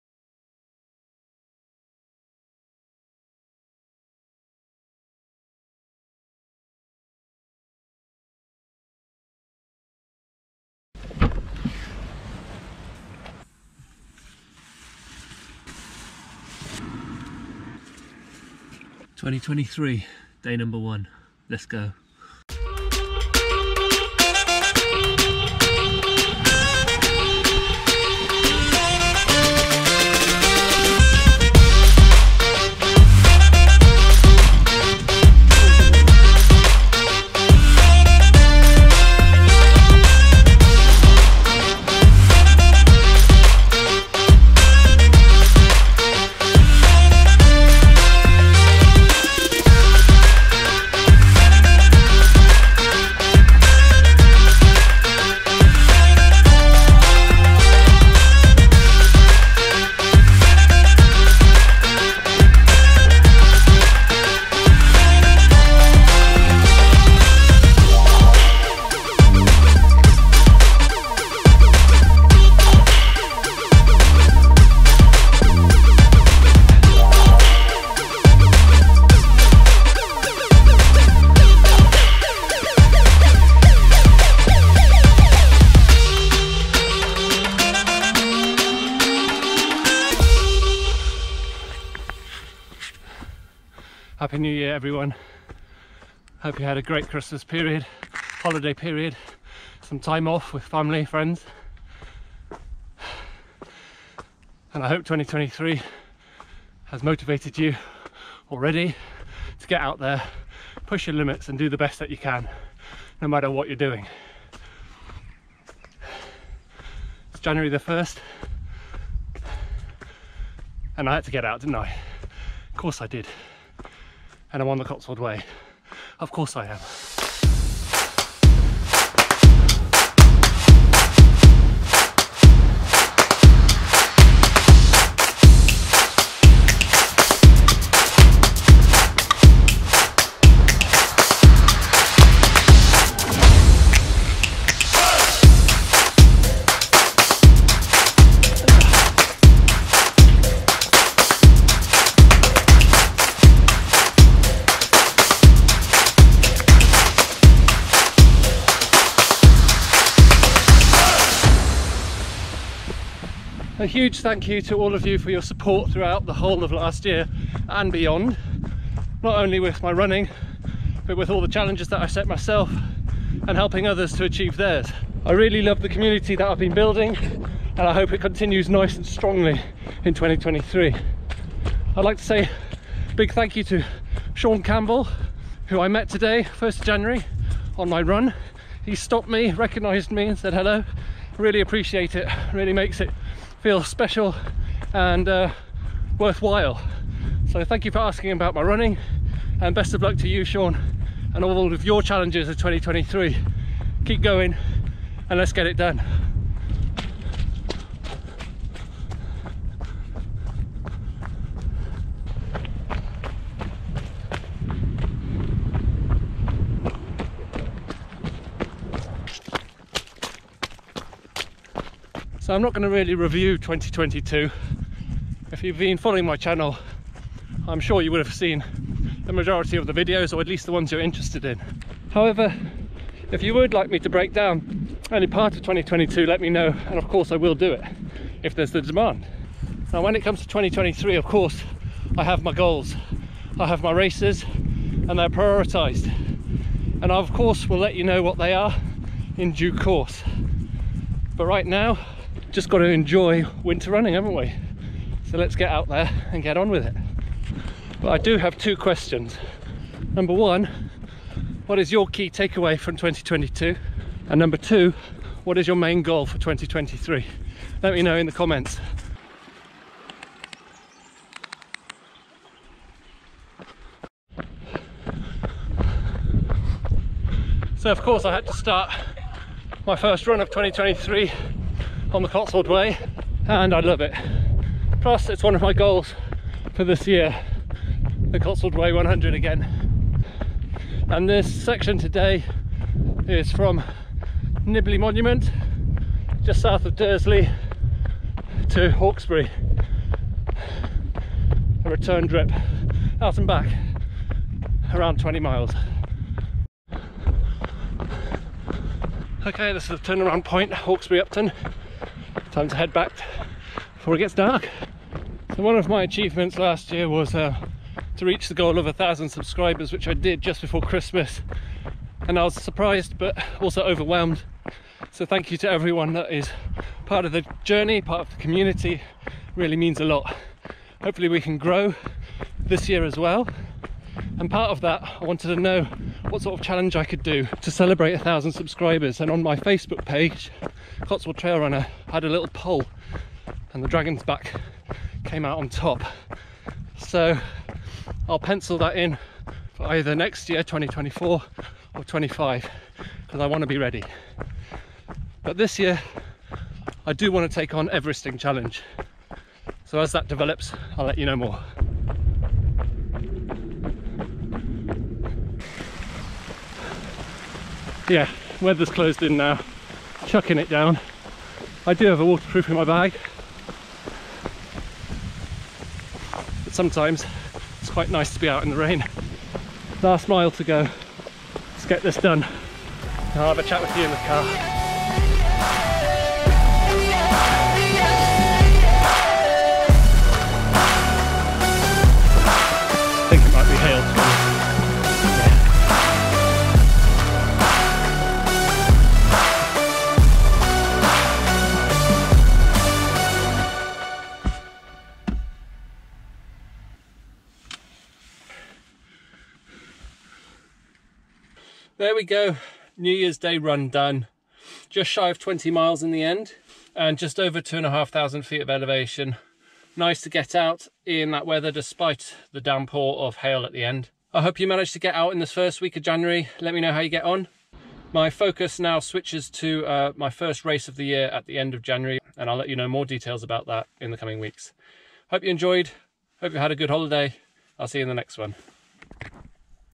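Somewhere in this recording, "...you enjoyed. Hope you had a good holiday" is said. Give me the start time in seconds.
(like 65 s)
435 s.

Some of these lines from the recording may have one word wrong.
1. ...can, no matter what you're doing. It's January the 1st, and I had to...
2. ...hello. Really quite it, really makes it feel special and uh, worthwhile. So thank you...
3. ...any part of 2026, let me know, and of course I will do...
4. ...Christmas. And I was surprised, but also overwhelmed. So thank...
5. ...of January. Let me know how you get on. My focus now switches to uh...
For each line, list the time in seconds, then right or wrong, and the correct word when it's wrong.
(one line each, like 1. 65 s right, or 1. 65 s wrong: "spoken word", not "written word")
1. 112 s right
2. 190 s wrong: "appreciate", not "quite"
3. 235 s wrong: "2022", not "2026"
4. 320 s right
5. 425 s right.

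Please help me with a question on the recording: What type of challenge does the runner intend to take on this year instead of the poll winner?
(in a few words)
Everesting Challenge.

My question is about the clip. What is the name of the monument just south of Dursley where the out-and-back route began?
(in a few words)
Nibley Monument.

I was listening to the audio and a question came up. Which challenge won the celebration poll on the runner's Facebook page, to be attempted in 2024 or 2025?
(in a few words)
Dragon's Back.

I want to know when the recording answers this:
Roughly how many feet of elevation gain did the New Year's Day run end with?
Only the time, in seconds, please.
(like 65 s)
417 s.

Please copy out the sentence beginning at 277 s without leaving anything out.
So of course I had to start my first run of 2023 on the Cotswold Way and I love it.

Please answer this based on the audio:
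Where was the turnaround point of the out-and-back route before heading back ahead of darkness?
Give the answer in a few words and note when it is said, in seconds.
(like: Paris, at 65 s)
Hawkesbury Upton, at 310 s.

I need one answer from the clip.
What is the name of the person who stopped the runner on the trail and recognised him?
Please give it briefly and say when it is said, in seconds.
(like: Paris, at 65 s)
Sean Campbell, at 184 s.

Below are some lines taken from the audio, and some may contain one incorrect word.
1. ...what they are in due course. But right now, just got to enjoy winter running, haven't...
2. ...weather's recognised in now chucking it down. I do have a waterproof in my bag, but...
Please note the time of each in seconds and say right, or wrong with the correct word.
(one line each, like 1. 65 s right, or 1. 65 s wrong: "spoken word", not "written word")
1. 248 s right
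2. 368 s wrong: "closed", not "recognised".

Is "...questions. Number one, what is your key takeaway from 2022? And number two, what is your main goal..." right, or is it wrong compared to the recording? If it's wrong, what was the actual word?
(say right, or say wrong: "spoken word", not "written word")
right.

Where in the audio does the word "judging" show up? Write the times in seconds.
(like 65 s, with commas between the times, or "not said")
not said.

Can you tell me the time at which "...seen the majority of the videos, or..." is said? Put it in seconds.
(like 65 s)
228 s.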